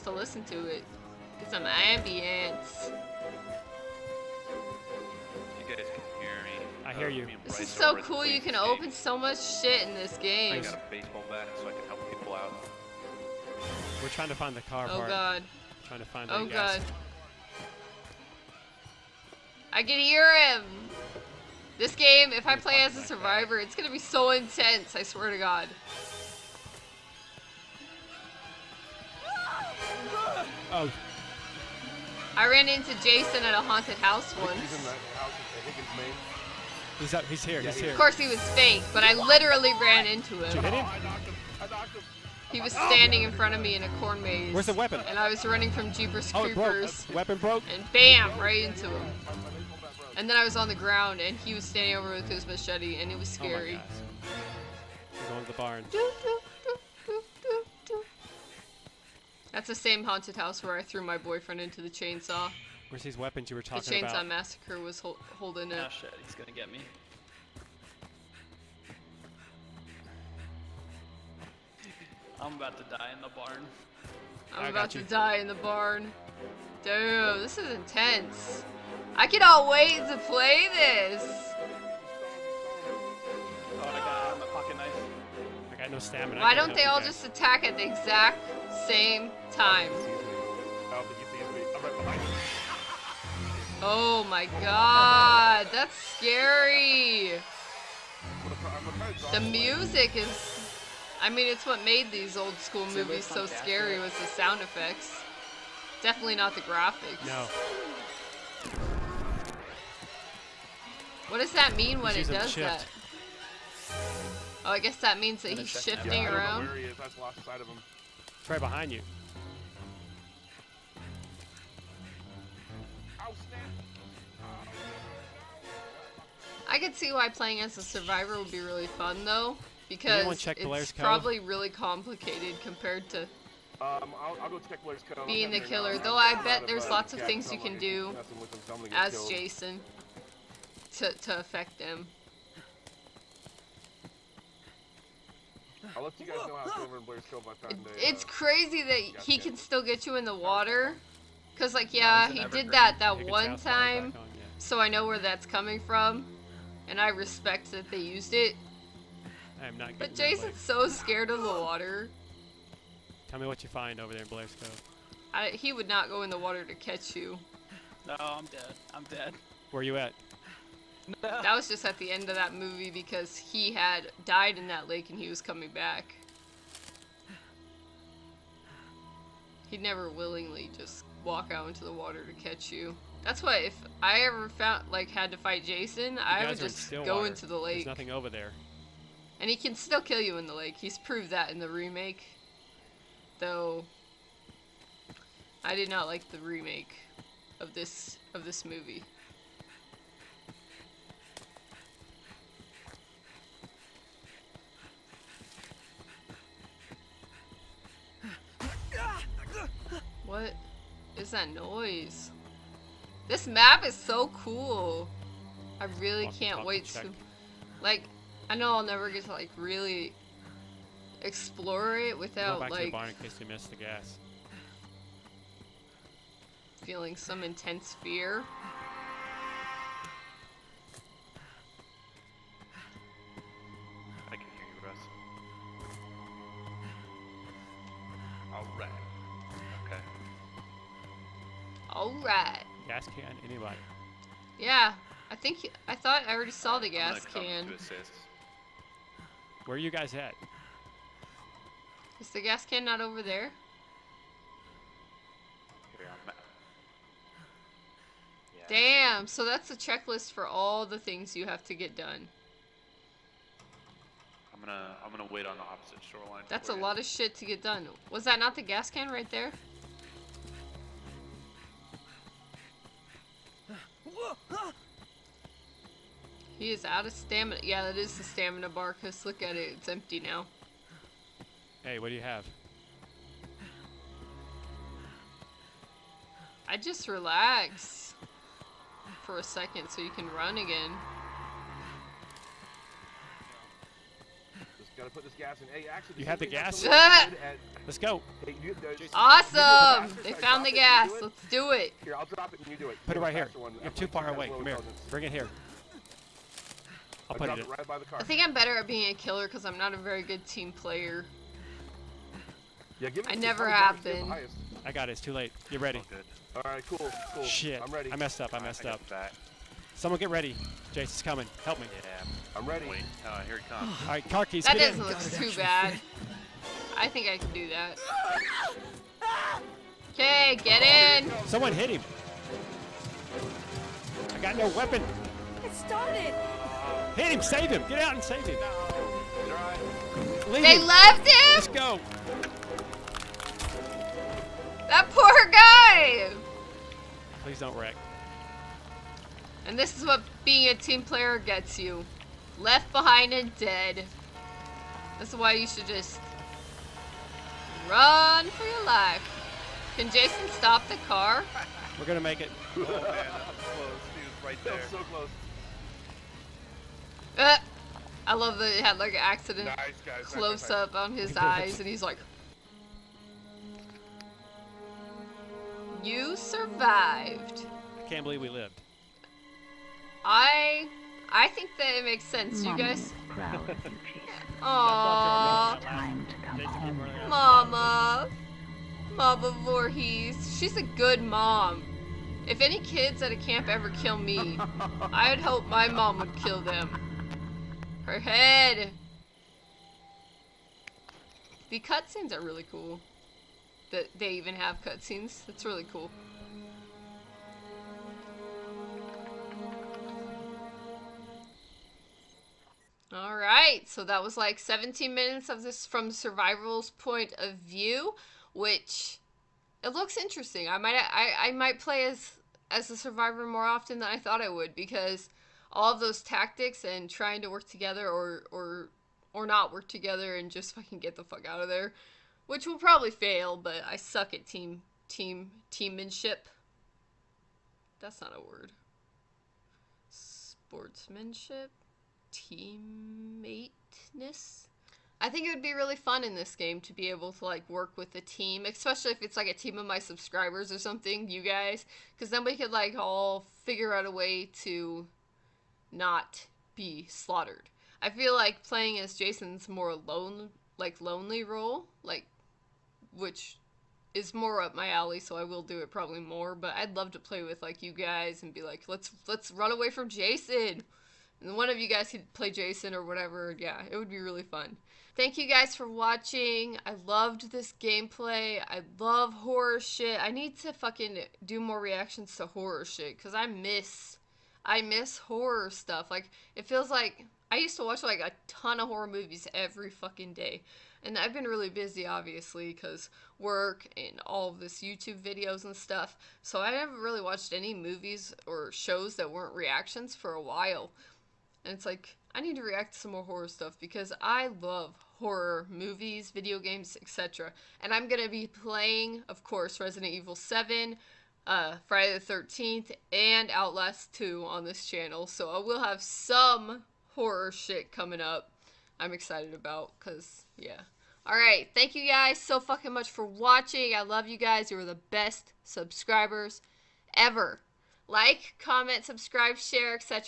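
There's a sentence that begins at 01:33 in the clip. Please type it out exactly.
Oh, oh my god, that's scary.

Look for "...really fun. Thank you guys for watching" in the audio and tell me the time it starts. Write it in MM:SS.
07:54.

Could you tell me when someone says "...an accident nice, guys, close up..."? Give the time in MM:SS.
06:09.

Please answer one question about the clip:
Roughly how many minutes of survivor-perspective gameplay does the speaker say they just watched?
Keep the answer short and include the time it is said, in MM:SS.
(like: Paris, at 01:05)
17, at 06:54.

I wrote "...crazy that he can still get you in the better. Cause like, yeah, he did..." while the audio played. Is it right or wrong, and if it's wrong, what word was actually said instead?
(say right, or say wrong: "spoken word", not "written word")
wrong: "water", not "better".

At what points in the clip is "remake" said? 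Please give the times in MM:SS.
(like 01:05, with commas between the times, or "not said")
03:11, 03:16.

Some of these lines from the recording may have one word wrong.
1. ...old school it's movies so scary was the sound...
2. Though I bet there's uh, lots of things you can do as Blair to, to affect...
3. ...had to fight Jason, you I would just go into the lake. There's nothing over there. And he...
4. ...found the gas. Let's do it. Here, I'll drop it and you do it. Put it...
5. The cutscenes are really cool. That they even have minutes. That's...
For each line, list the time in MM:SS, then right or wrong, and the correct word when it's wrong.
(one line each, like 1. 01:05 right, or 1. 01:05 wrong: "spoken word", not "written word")
1. 01:42 right
2. 02:15 wrong: "Jason", not "Blair"
3. 03:05 right
4. 05:00 right
5. 06:41 wrong: "cutscenes", not "minutes".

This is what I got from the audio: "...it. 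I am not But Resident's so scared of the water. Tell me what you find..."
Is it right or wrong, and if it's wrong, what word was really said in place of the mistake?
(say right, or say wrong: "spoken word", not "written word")
wrong: "Jason", not "Resident".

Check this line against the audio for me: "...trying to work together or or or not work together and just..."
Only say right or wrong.
right.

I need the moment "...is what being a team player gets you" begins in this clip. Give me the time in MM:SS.
05:49.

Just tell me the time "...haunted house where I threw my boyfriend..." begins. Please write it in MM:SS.
01:00.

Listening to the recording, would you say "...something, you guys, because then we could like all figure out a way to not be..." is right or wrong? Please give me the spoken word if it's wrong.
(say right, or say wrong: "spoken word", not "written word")
right.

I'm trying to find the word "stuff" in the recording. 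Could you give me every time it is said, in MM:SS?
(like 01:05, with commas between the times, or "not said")
08:05, 08:15, 08:23.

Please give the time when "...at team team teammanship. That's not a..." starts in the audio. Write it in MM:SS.
07:14.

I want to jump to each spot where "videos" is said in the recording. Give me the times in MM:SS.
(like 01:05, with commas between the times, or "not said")
08:15, 08:26.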